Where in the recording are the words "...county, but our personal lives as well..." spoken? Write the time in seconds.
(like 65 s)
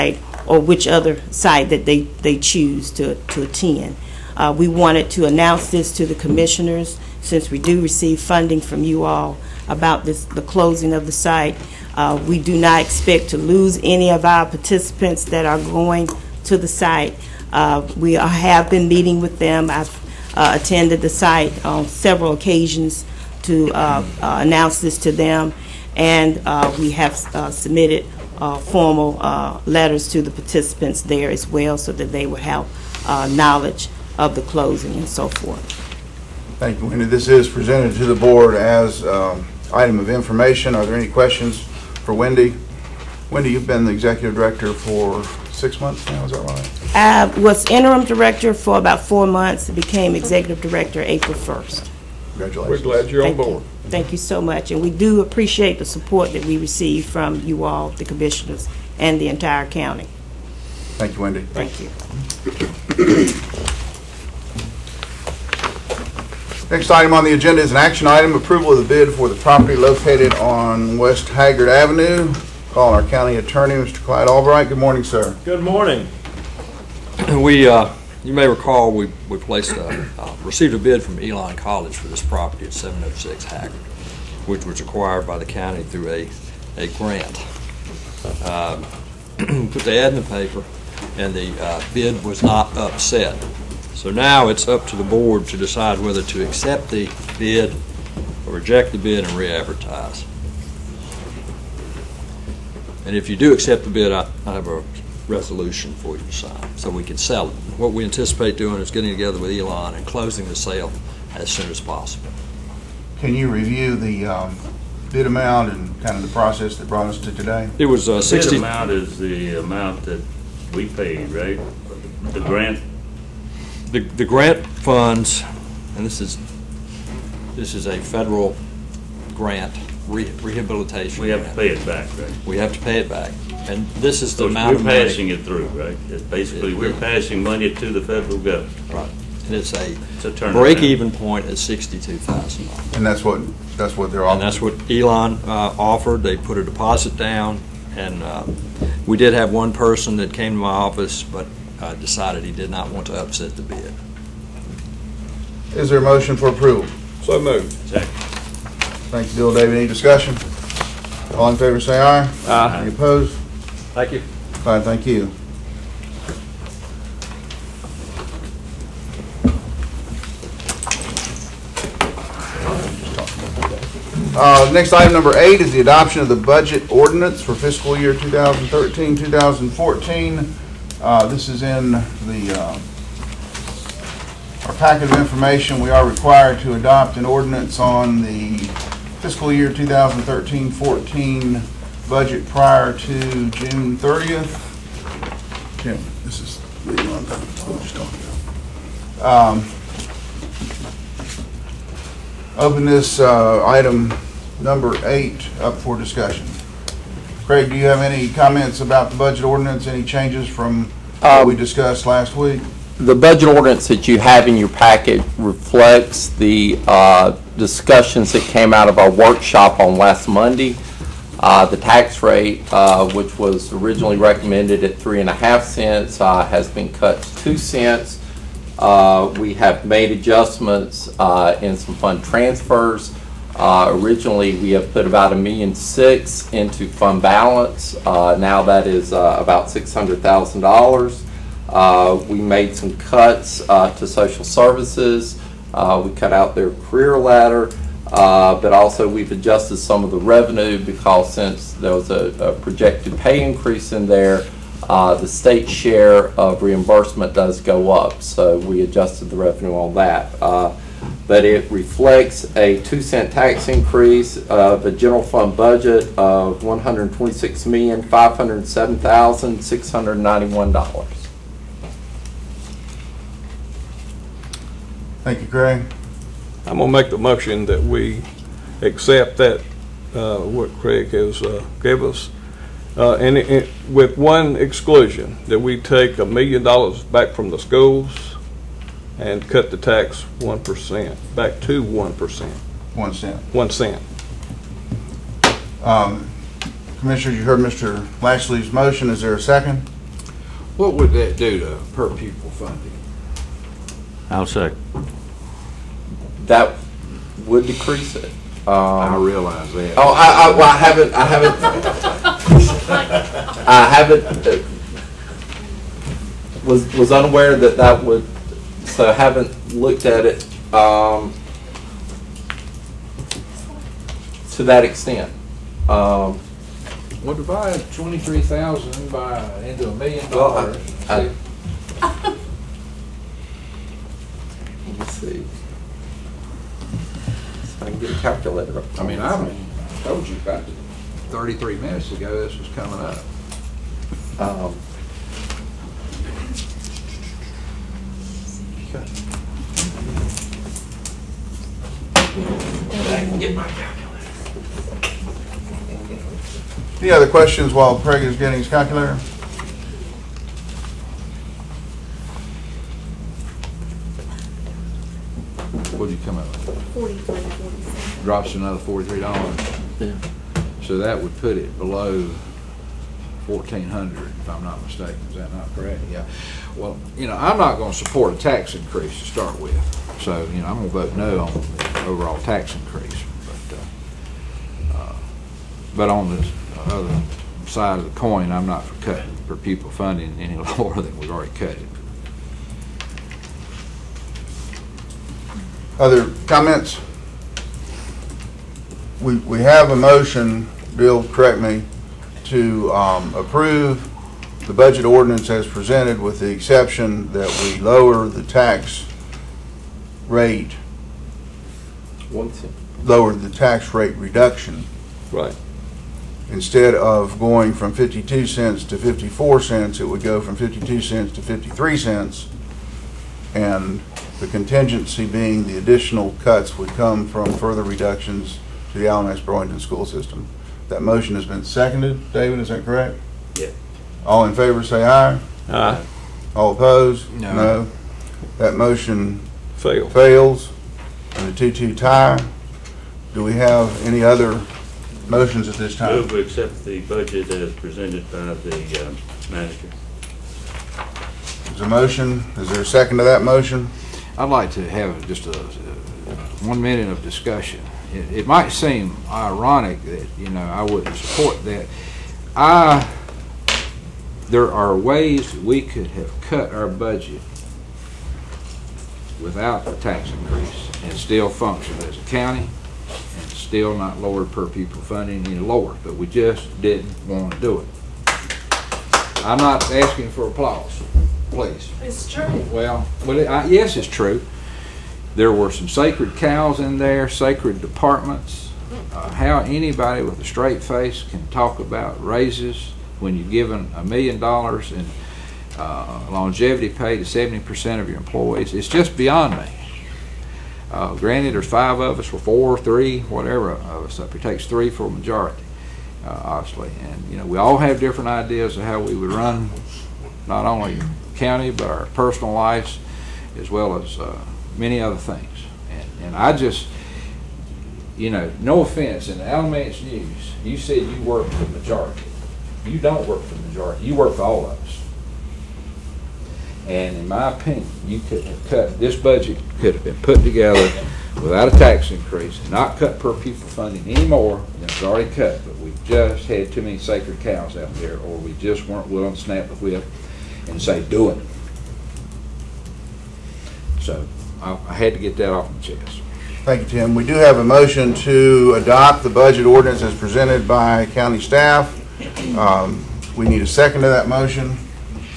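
511 s.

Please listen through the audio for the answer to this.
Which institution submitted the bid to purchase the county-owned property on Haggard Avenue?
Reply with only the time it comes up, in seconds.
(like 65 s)
81 s.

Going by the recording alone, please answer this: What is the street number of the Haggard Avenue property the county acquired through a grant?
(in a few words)
706.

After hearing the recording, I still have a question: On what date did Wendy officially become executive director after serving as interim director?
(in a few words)
April 1st.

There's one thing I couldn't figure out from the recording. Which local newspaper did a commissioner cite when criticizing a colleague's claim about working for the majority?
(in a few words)
Alamance News.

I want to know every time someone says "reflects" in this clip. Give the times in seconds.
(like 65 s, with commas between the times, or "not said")
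215 s, 261 s.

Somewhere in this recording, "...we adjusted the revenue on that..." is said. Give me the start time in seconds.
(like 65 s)
258 s.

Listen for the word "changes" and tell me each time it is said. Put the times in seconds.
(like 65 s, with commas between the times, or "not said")
210 s.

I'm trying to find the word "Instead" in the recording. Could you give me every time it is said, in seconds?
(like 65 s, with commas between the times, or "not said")
416 s.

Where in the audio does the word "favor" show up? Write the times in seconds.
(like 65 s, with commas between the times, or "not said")
161 s, 434 s.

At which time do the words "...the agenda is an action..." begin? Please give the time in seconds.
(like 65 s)
67 s.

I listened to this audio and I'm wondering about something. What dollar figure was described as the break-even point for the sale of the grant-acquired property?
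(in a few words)
$62,000.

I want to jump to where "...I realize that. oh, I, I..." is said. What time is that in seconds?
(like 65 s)
308 s.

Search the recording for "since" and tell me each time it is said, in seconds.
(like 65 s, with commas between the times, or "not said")
7 s, 251 s.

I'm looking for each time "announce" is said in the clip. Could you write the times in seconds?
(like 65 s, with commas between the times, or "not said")
5 s, 24 s.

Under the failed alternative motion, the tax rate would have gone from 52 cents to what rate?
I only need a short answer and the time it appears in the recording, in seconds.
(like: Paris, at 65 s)
53 cents, at 421 s.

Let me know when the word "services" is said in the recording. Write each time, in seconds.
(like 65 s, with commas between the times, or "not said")
244 s.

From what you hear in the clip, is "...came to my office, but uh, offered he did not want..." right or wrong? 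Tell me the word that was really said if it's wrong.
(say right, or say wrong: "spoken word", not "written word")
wrong: "decided", not "offered".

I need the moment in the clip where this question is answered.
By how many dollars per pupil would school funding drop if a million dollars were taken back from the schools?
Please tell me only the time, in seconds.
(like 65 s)
367 s.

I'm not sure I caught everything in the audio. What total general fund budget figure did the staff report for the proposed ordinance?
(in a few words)
$126,507,691.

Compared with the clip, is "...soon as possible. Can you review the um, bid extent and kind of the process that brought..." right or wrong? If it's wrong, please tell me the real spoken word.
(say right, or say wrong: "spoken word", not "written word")
wrong: "amount", not "extent".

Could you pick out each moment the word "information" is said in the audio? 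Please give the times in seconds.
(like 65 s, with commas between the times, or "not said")
40 s, 185 s.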